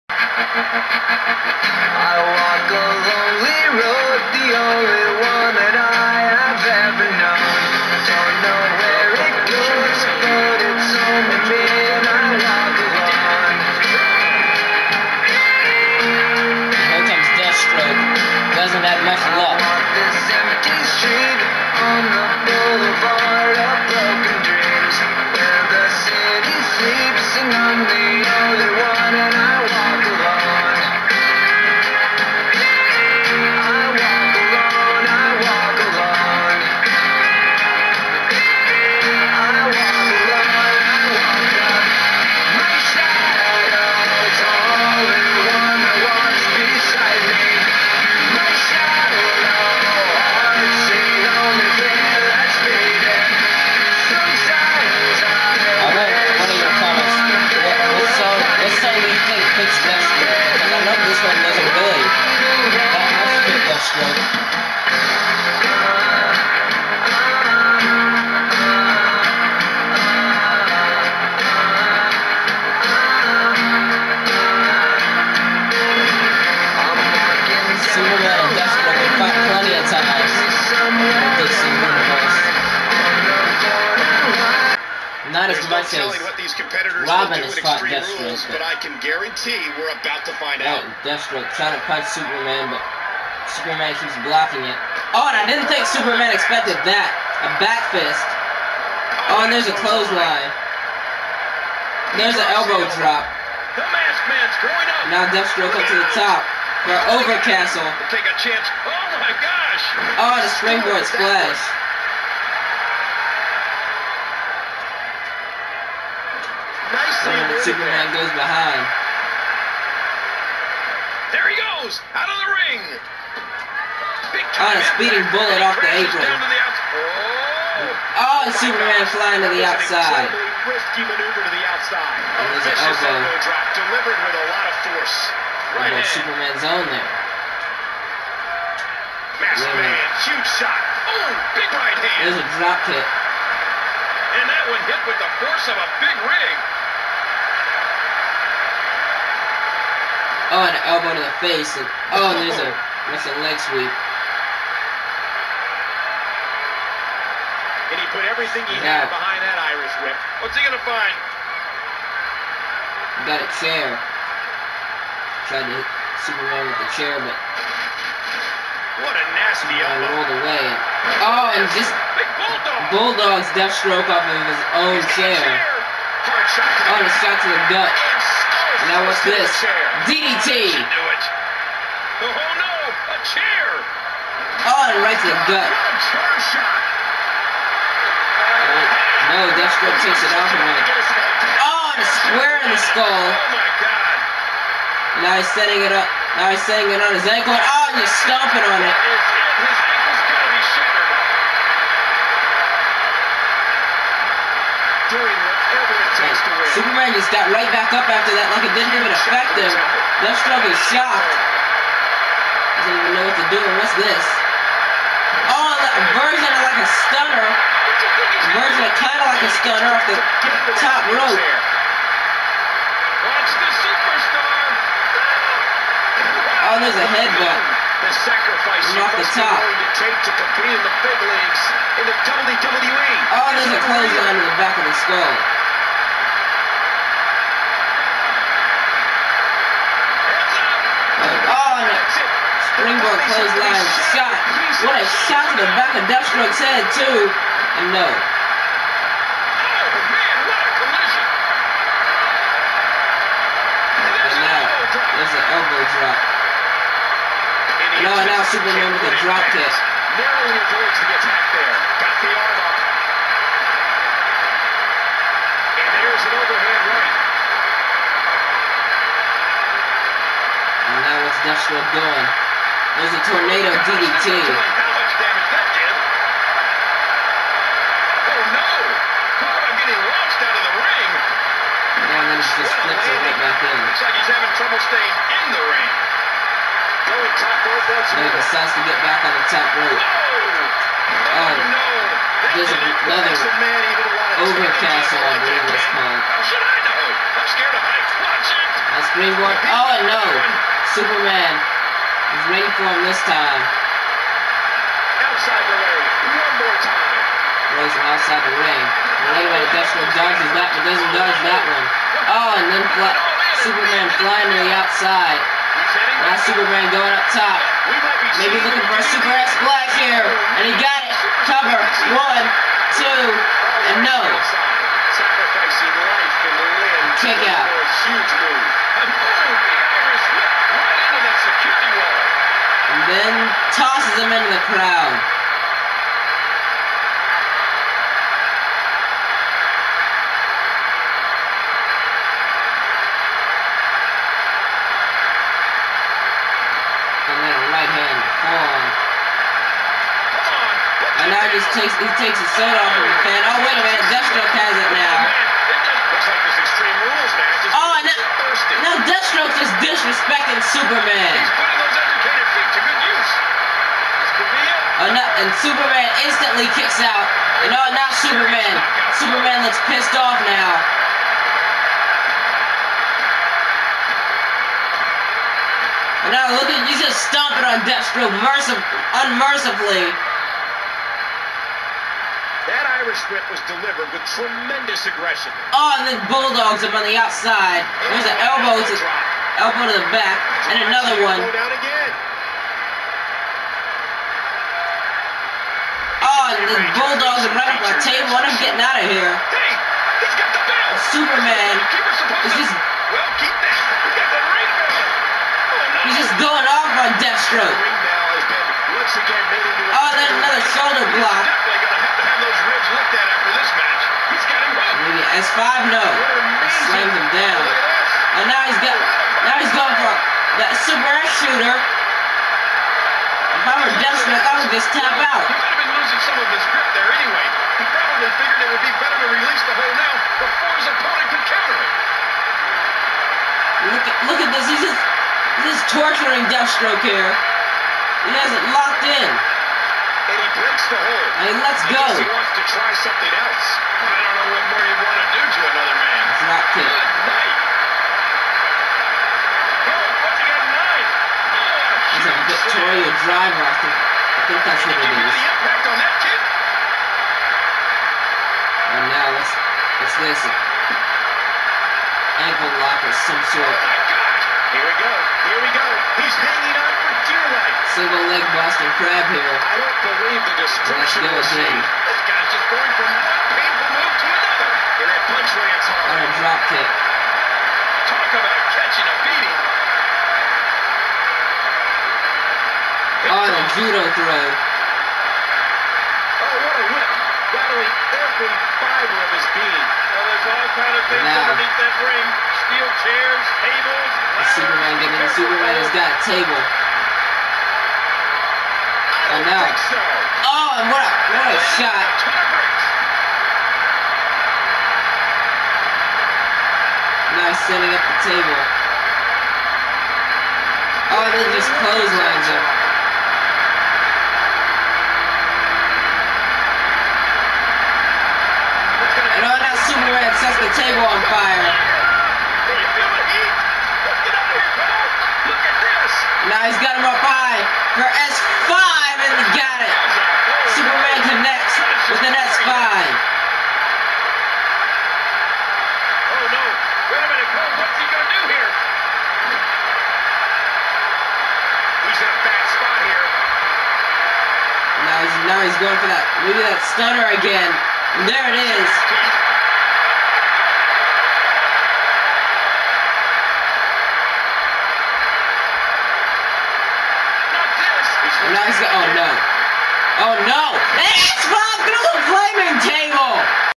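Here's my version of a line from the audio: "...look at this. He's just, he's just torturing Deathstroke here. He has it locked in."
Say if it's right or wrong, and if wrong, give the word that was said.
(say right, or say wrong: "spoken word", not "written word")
right.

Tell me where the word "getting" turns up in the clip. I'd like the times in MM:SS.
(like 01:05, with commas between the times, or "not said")
04:39, 06:38, 08:15.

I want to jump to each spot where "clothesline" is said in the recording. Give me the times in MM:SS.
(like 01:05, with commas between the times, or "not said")
01:39, 03:53, 04:03, 08:31.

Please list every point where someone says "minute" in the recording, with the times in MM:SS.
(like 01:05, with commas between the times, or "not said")
05:53, 08:57.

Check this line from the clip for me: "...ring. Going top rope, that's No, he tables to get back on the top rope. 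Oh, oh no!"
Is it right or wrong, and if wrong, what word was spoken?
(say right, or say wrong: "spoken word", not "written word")
wrong: "decides", not "tables".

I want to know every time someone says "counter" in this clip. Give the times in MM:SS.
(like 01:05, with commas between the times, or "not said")
07:11.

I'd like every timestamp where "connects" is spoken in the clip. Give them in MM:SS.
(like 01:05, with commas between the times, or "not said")
08:51.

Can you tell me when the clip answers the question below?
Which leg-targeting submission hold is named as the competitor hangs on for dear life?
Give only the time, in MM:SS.
07:47.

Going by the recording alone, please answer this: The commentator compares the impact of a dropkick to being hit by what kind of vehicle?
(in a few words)
a big rig.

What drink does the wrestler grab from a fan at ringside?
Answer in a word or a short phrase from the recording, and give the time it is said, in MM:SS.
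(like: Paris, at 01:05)
Soda, at 05:52.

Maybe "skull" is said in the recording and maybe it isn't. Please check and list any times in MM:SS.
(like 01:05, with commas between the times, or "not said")
03:12, 03:55.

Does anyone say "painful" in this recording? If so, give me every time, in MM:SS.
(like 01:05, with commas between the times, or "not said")
07:53.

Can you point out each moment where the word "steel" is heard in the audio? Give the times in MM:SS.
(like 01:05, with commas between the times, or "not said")
08:12.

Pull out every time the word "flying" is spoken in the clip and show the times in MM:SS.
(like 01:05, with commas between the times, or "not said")
02:09, 05:14.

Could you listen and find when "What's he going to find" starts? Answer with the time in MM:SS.
02:40.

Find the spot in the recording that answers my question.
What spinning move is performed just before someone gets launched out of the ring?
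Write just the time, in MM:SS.
04:33.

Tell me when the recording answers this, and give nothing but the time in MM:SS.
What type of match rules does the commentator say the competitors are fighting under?
01:27.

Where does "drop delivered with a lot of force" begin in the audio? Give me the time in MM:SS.
02:13.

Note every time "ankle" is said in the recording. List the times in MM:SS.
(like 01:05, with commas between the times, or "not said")
03:17, 07:42.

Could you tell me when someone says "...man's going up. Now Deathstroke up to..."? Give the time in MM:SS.
01:44.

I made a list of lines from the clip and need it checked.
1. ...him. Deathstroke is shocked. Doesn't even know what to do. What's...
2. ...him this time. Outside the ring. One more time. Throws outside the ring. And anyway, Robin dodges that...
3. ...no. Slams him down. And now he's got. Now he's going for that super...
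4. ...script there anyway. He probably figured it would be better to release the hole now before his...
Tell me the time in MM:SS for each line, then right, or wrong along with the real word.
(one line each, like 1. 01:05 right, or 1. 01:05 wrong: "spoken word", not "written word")
1. 03:29 right
2. 05:02 wrong: "Dutchman", not "Robin"
3. 06:55 right
4. 07:06 right.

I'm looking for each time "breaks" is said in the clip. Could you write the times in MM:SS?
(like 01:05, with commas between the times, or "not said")
07:20.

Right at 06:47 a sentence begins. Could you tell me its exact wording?
The Oh, then another shoulder block.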